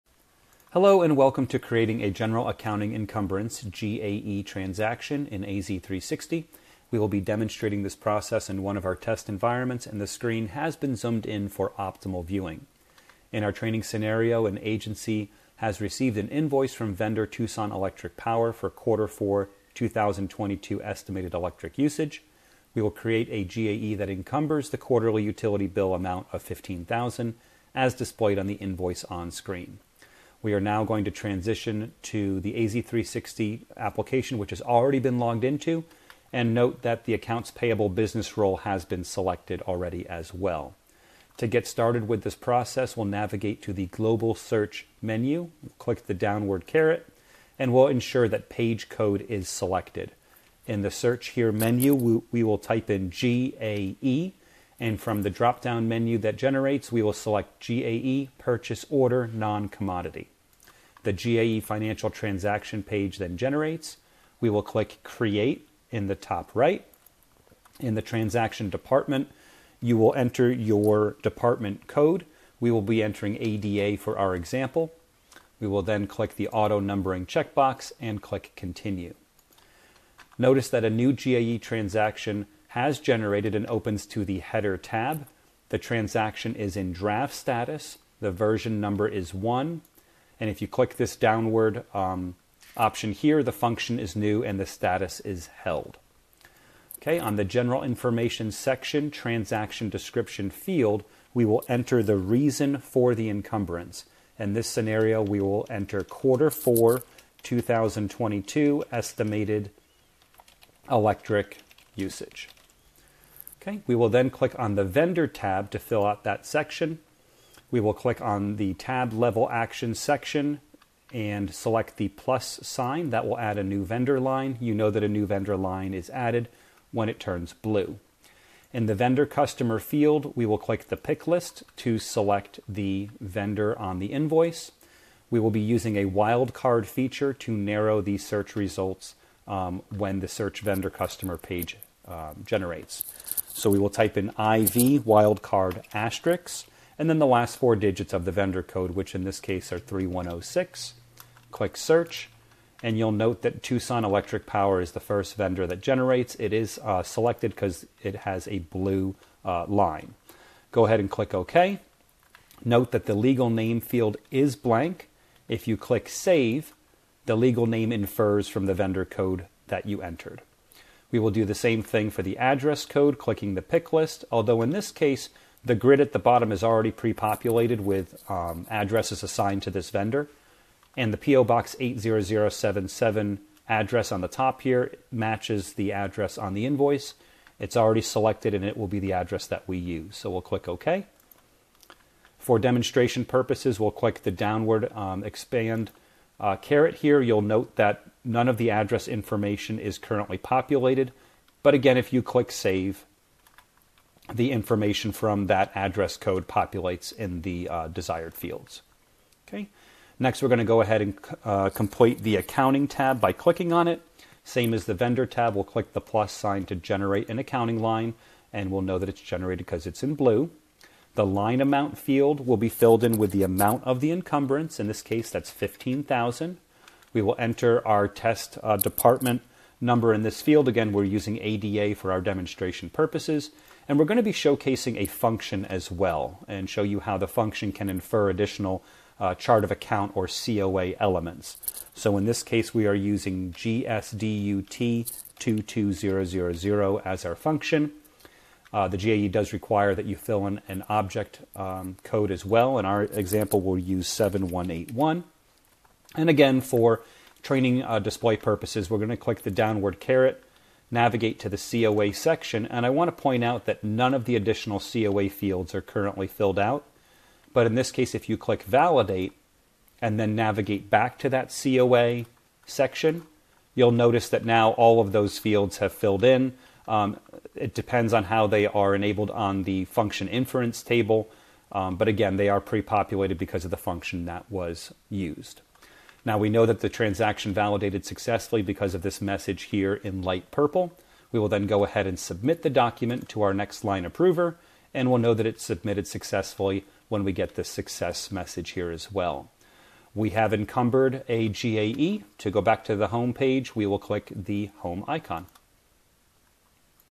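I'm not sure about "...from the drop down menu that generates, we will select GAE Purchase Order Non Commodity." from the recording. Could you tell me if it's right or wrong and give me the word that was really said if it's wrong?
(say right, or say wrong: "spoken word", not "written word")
right.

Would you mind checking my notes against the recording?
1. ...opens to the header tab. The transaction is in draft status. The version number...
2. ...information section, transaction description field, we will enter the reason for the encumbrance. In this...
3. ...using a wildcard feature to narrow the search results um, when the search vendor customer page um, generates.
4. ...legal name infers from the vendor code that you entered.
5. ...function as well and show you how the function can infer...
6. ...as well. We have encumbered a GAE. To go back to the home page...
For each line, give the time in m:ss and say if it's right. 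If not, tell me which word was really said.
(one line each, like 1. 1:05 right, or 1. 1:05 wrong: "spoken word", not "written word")
1. 1:23 right
2. 1:37 right
3. 2:15 right
4. 2:47 right
5. 3:55 right
6. 4:58 right.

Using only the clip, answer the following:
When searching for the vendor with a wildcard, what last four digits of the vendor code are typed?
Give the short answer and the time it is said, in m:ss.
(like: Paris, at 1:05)
3106, at 2:29.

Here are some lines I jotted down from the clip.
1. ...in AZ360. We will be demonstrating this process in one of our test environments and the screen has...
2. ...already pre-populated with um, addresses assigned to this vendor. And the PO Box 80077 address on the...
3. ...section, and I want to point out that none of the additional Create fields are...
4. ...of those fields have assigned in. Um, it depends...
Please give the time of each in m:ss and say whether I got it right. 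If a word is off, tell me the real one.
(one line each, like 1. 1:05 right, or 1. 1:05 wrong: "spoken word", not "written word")
1. 0:05 right
2. 2:56 right
3. 4:22 wrong: "COA", not "Create"
4. 4:35 wrong: "filled", not "assigned".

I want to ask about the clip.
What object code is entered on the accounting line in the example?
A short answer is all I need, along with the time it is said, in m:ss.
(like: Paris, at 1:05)
7181, at 4:14.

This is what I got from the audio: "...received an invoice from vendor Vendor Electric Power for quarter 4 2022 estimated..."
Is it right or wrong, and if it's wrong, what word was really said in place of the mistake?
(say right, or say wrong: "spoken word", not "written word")
wrong: "Tucson", not "Vendor".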